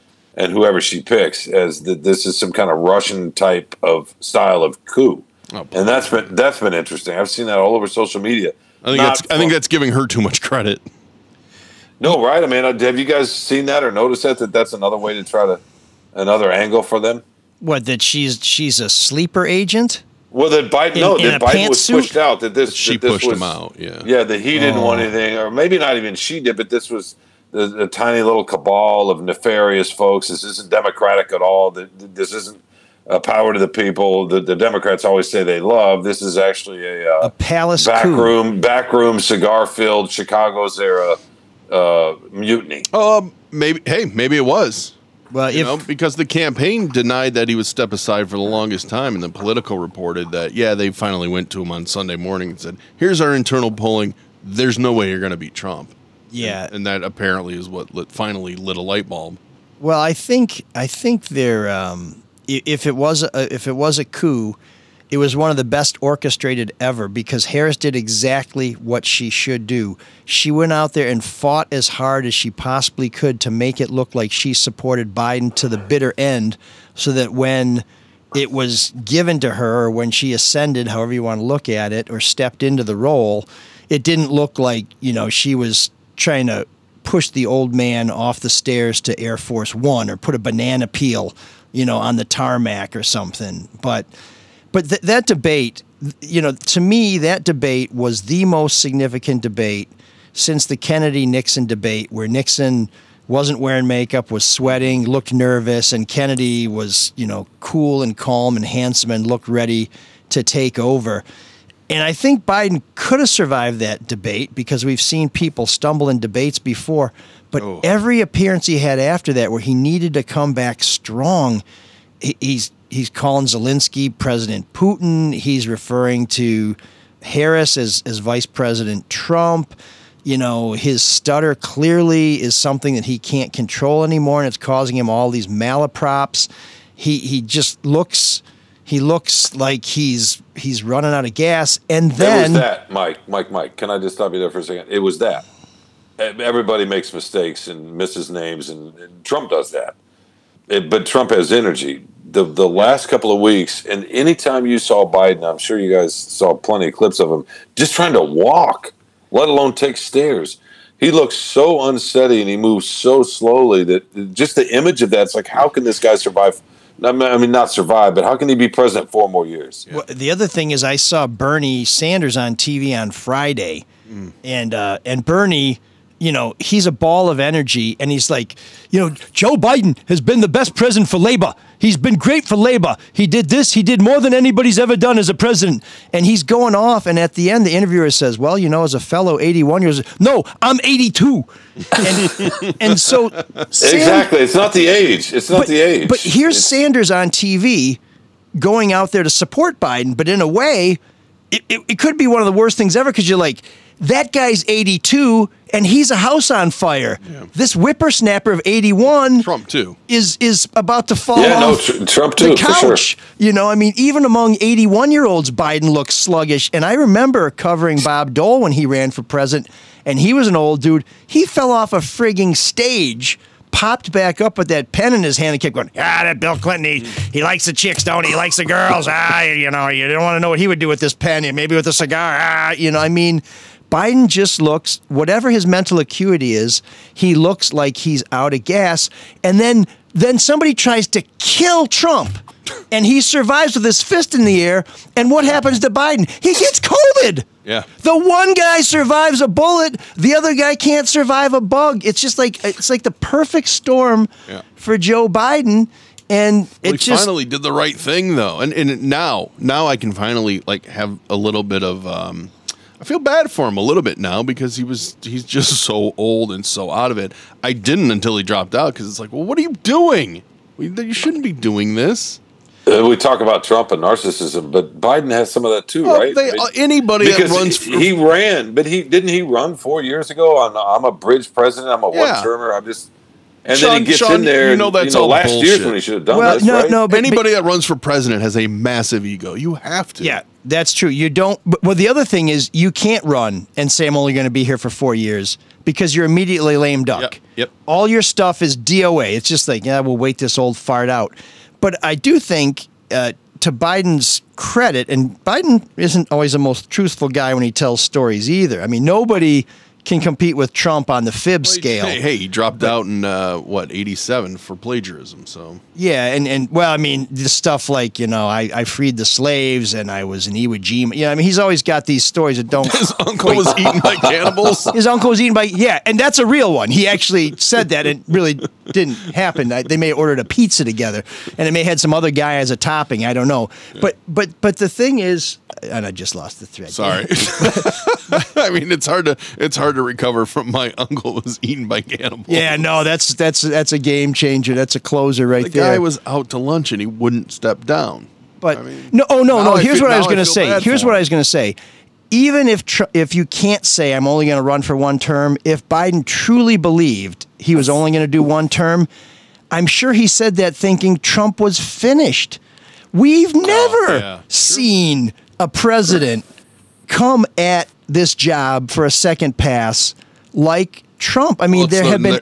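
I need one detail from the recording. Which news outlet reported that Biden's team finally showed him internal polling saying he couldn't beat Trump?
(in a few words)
Politico.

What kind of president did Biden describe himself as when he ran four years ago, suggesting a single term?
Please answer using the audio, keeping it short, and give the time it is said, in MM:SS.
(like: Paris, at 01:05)
A bridge president, at 04:41.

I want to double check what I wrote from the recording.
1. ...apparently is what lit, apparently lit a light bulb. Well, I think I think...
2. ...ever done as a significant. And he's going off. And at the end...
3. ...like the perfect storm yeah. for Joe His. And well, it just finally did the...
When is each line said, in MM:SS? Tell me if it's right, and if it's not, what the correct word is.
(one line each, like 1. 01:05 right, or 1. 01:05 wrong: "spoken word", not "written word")
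1. 00:57 wrong: "finally", not "apparently"
2. 03:04 wrong: "president", not "significant"
3. 04:12 wrong: "Biden", not "His".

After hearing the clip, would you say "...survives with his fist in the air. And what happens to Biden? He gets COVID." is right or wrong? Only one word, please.
right.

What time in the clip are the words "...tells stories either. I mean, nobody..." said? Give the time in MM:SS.
05:07.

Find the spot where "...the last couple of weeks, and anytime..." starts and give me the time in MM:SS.
02:32.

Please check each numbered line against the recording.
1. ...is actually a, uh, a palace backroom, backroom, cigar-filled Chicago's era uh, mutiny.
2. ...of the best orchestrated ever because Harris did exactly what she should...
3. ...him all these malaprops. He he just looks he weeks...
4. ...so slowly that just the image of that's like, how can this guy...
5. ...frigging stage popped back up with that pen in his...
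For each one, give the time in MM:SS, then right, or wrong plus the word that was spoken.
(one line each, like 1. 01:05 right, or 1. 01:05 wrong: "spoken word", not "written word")
1. 00:36 right
2. 01:05 right
3. 02:14 wrong: "looks", not "weeks"
4. 02:42 right
5. 03:41 right.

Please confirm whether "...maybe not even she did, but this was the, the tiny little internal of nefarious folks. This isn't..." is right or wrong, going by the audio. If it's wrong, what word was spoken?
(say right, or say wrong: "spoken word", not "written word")
wrong: "cabal", not "internal".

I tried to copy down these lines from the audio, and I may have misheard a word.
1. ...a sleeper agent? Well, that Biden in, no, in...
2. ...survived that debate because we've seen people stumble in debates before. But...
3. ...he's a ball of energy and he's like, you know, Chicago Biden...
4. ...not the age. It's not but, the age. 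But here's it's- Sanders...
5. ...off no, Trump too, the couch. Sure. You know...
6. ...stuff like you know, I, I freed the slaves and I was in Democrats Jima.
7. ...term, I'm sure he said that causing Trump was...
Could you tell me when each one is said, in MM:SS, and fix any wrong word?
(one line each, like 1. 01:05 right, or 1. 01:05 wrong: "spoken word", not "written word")
1. 00:18 right
2. 01:53 right
3. 02:56 wrong: "Joe", not "Chicago"
4. 03:14 right
5. 03:31 right
6. 05:17 wrong: "Iwo", not "Democrats"
7. 05:58 wrong: "thinking", not "causing".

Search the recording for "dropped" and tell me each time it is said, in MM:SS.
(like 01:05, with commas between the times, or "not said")
04:28, 05:12.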